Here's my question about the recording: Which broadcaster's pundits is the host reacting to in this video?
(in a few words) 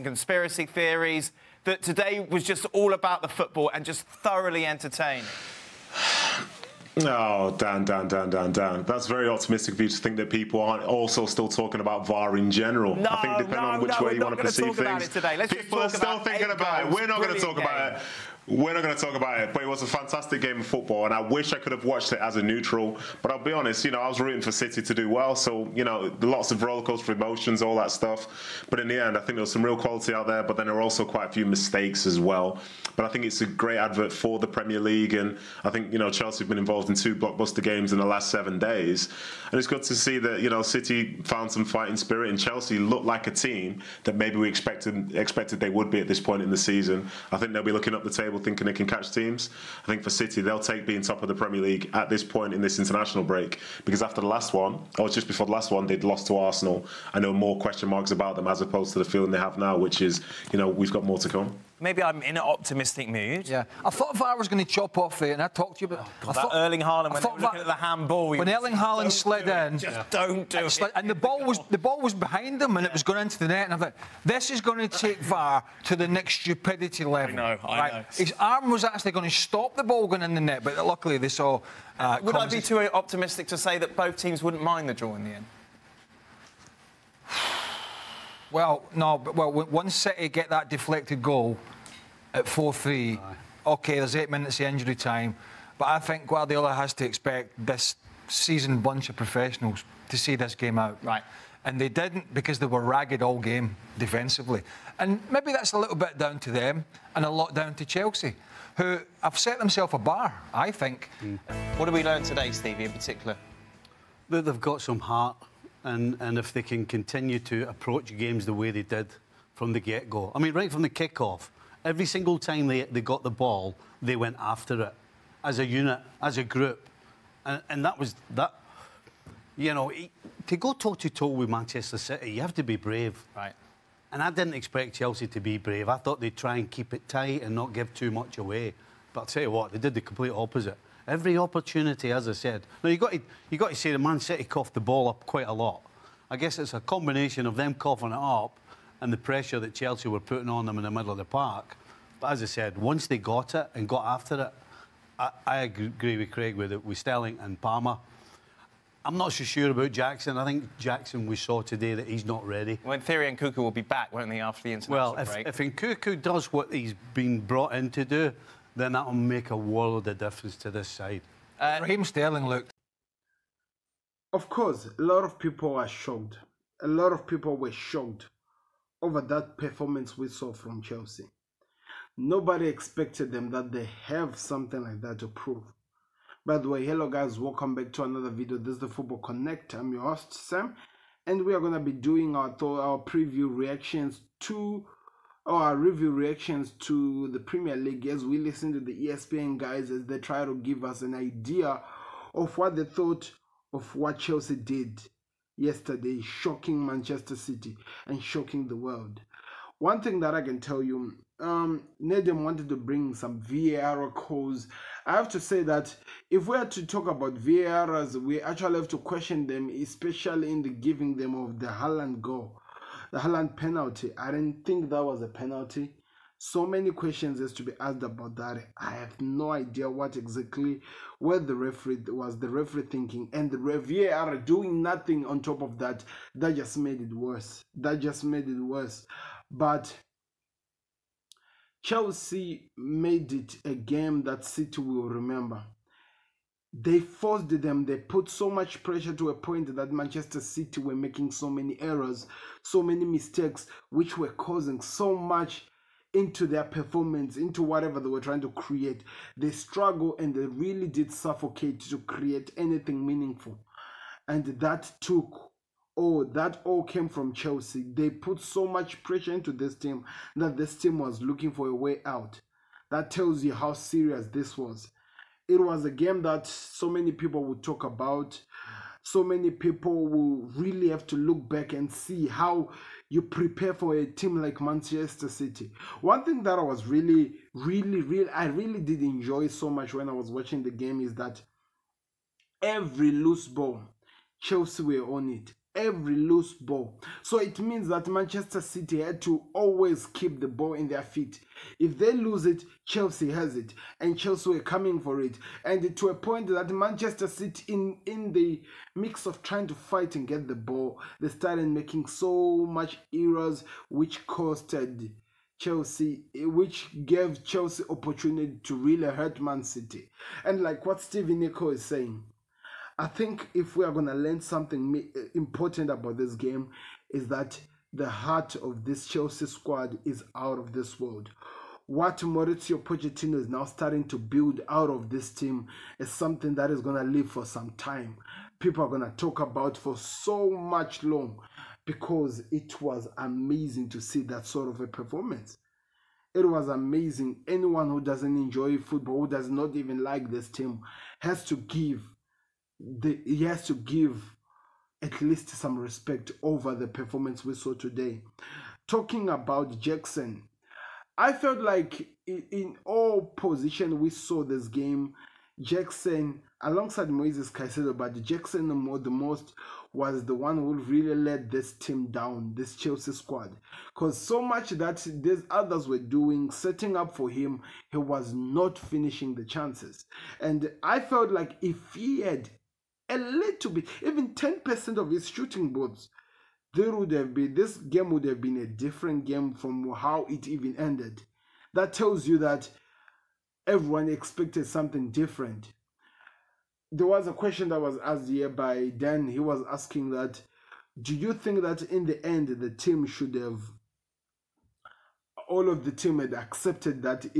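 ESPN.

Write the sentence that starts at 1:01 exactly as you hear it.
Maybe I'm in an optimistic mood.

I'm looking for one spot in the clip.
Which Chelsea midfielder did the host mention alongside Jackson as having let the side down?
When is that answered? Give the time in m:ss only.
6:07.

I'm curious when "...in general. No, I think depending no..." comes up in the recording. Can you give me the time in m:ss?
0:12.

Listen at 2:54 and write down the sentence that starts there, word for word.
Of course, a lot of people are shocked.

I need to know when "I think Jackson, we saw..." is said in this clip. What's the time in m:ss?
2:40.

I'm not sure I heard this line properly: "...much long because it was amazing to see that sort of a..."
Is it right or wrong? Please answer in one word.
right.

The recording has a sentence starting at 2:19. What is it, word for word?
But I'll tell you what, they did the complete opposite.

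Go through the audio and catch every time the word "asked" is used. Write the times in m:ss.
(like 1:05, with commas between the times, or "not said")
3:47, 6:38.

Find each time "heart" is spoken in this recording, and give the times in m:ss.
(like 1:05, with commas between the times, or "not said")
1:54, 5:28.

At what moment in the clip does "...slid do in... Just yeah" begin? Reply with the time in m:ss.
1:09.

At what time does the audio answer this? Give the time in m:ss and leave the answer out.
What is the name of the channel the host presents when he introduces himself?
3:08.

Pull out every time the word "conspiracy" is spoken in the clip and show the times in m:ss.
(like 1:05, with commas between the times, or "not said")
0:00.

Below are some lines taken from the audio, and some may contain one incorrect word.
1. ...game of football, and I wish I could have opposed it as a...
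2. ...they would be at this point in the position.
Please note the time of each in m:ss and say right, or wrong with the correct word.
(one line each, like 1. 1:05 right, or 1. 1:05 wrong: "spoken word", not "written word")
1. 0:20 wrong: "watched", not "opposed"
2. 0:45 wrong: "season", not "position".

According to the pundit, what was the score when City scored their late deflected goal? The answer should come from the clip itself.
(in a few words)
4-3.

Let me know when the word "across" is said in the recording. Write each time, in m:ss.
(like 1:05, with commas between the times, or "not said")
not said.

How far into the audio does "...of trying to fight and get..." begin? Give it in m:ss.
5:09.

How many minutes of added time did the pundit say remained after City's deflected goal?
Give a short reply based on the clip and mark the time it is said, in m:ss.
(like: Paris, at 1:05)
8, at 1:34.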